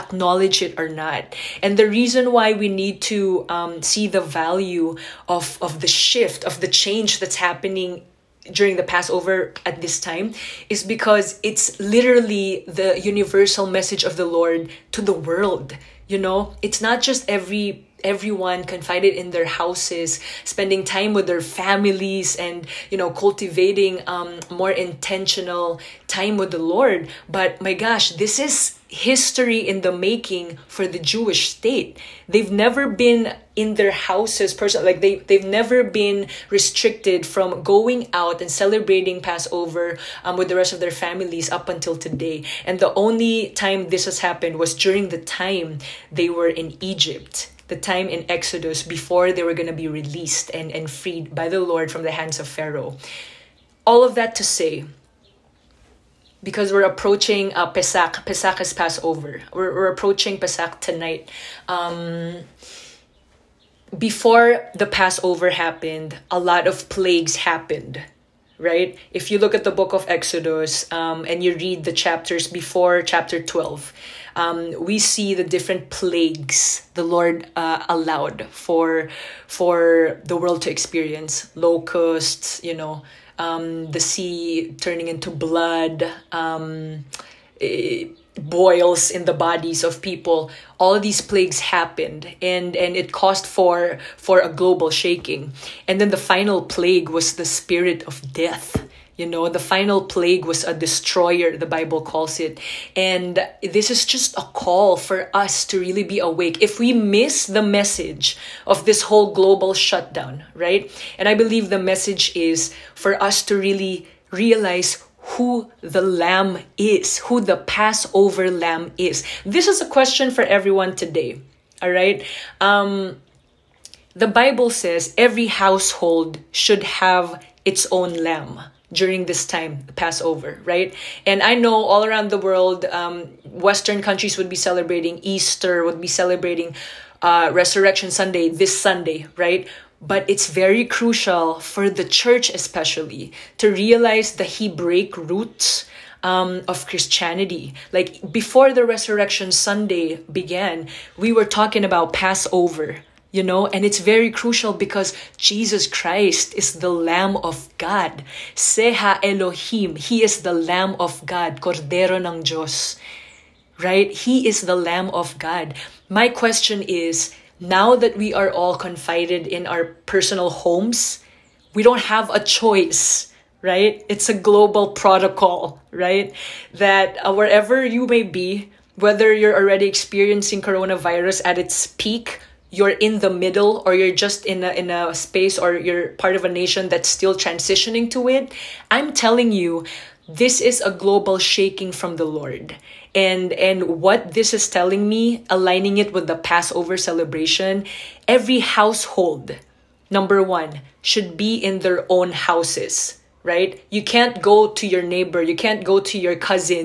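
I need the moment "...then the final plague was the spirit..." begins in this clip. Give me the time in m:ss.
1:36.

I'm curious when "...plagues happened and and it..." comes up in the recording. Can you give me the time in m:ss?
1:31.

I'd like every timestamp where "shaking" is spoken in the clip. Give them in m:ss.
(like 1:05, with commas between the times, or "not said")
1:34, 3:11.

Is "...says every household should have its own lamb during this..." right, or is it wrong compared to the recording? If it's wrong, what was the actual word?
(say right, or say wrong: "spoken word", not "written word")
right.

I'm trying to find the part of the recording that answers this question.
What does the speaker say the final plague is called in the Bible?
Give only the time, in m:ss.
1:40.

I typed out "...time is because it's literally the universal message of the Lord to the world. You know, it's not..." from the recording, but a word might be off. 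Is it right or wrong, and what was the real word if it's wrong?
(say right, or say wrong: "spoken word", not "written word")
right.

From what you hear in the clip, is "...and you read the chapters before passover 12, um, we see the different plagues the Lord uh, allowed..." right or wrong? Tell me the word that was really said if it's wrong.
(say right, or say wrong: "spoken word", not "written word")
wrong: "chapter", not "passover".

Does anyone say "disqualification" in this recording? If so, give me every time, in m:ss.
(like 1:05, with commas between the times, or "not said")
not said.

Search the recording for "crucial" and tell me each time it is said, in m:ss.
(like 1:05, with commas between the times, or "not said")
2:20, 2:34.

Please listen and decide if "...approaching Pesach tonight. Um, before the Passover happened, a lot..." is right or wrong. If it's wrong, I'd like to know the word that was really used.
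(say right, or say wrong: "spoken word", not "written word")
right.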